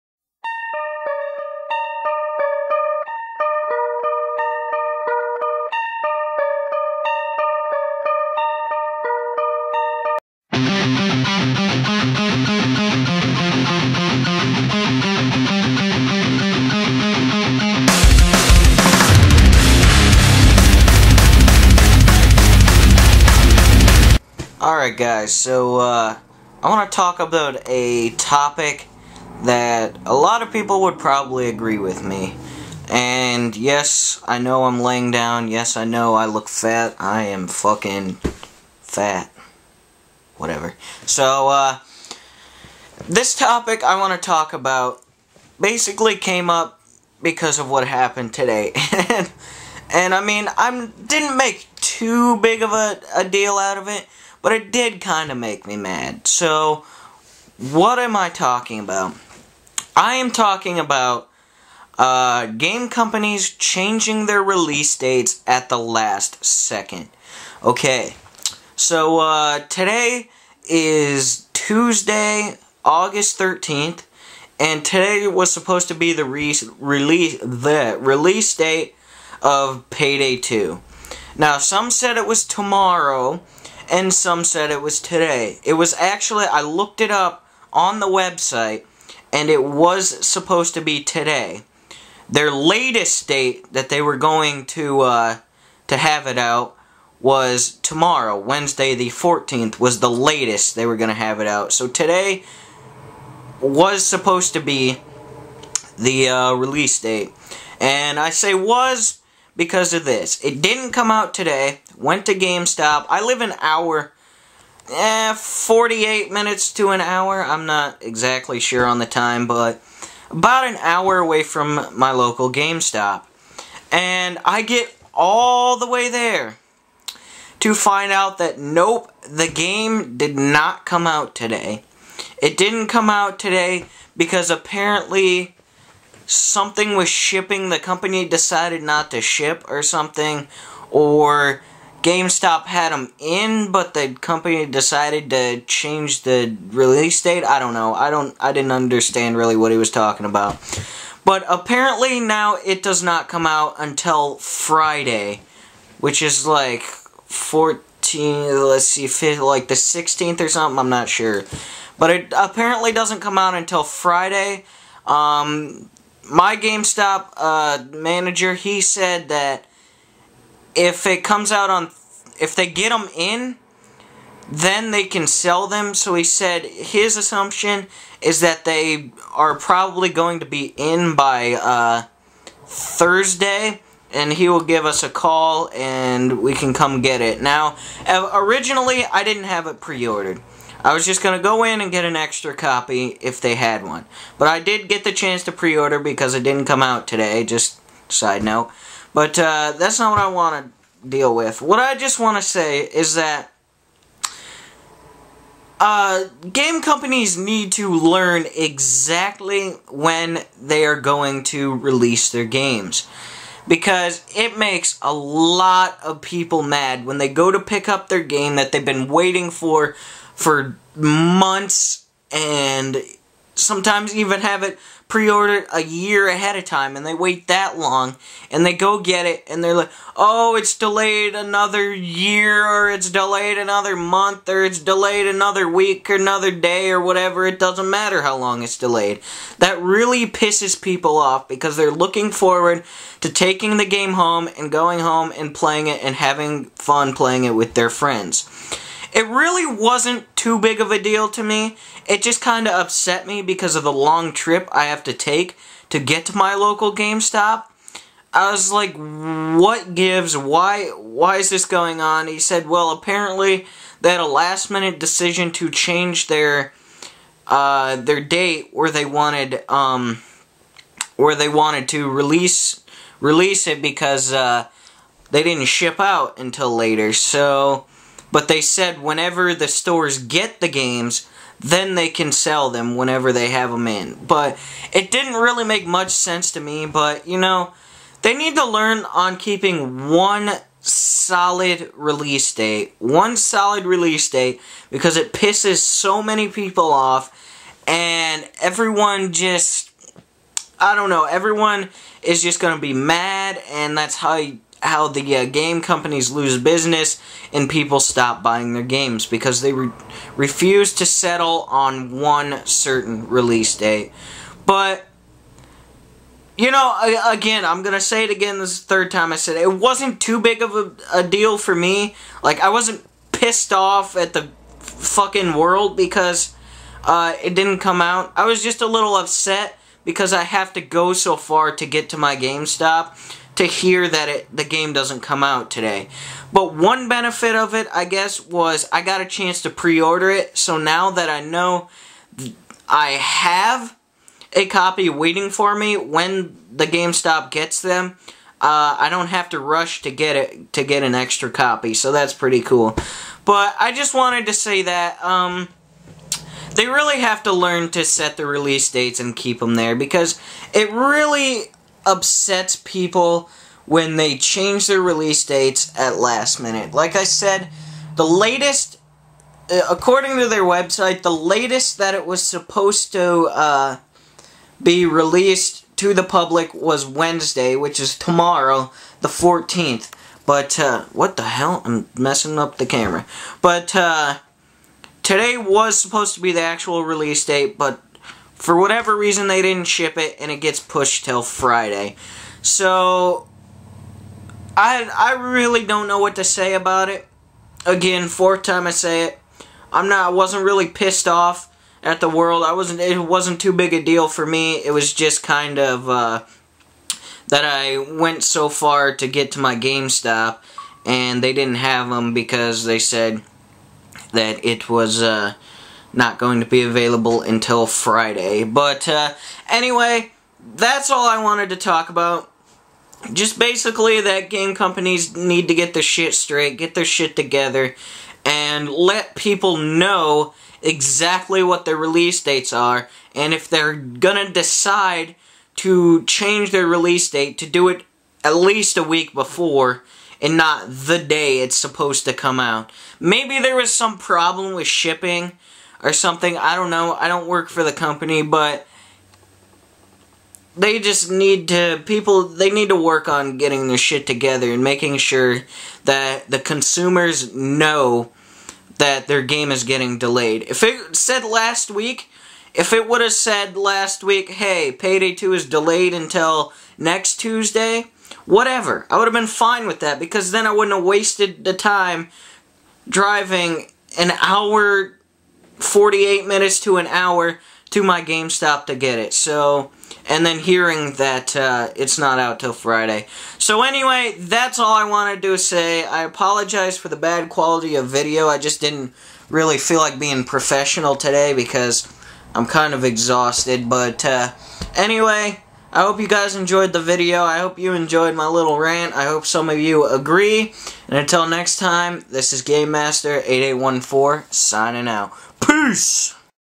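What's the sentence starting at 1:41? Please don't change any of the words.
So today was supposed to be the uh, release date.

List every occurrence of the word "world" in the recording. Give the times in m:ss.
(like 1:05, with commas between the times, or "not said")
5:25, 6:42.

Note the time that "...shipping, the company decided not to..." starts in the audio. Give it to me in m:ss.
2:17.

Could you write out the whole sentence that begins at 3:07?
Now, uh, originally, I didn't have it pre ordered.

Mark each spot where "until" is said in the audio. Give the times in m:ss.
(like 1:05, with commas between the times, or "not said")
2:33, 2:43, 4:36, 6:57, 7:46, 8:21.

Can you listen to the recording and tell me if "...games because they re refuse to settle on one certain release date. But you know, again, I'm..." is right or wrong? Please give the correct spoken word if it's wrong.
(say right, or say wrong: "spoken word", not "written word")
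right.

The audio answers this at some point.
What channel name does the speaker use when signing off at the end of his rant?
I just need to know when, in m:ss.
8:22.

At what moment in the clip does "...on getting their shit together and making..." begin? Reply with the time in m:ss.
7:33.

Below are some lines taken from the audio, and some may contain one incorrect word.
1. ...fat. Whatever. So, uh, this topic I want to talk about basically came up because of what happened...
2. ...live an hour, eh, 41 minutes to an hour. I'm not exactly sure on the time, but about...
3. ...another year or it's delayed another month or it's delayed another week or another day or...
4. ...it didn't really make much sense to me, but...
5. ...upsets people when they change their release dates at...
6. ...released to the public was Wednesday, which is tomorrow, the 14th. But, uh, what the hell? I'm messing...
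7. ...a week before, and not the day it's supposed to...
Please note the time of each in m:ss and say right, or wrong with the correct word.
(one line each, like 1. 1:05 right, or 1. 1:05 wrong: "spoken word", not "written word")
1. 0:38 right
2. 1:53 wrong: "48", not "41"
3. 3:51 right
4. 4:44 right
5. 6:02 right
6. 6:15 right
7. 7:18 right.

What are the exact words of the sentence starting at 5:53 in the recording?
But I just wanted to say that.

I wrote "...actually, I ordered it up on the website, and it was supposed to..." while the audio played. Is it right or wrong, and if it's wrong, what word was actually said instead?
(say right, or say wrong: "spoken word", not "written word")
wrong: "looked", not "ordered".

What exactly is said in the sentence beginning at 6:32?
So I I really don't know what to say about it.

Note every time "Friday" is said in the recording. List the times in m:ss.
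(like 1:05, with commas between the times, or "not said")
2:34, 2:43, 6:31, 6:57, 8:02.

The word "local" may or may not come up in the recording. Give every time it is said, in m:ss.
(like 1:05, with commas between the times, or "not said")
2:02, 4:16.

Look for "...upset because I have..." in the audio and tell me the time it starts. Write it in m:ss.
5:29.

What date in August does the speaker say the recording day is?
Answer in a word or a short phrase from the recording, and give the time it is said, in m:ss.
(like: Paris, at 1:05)
August 13th, at 1:12.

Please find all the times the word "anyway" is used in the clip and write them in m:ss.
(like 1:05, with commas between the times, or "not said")
6:59, 8:03, 8:14.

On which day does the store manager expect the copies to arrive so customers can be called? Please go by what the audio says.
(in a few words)
Thursday.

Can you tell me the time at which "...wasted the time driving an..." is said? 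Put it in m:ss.
7:51.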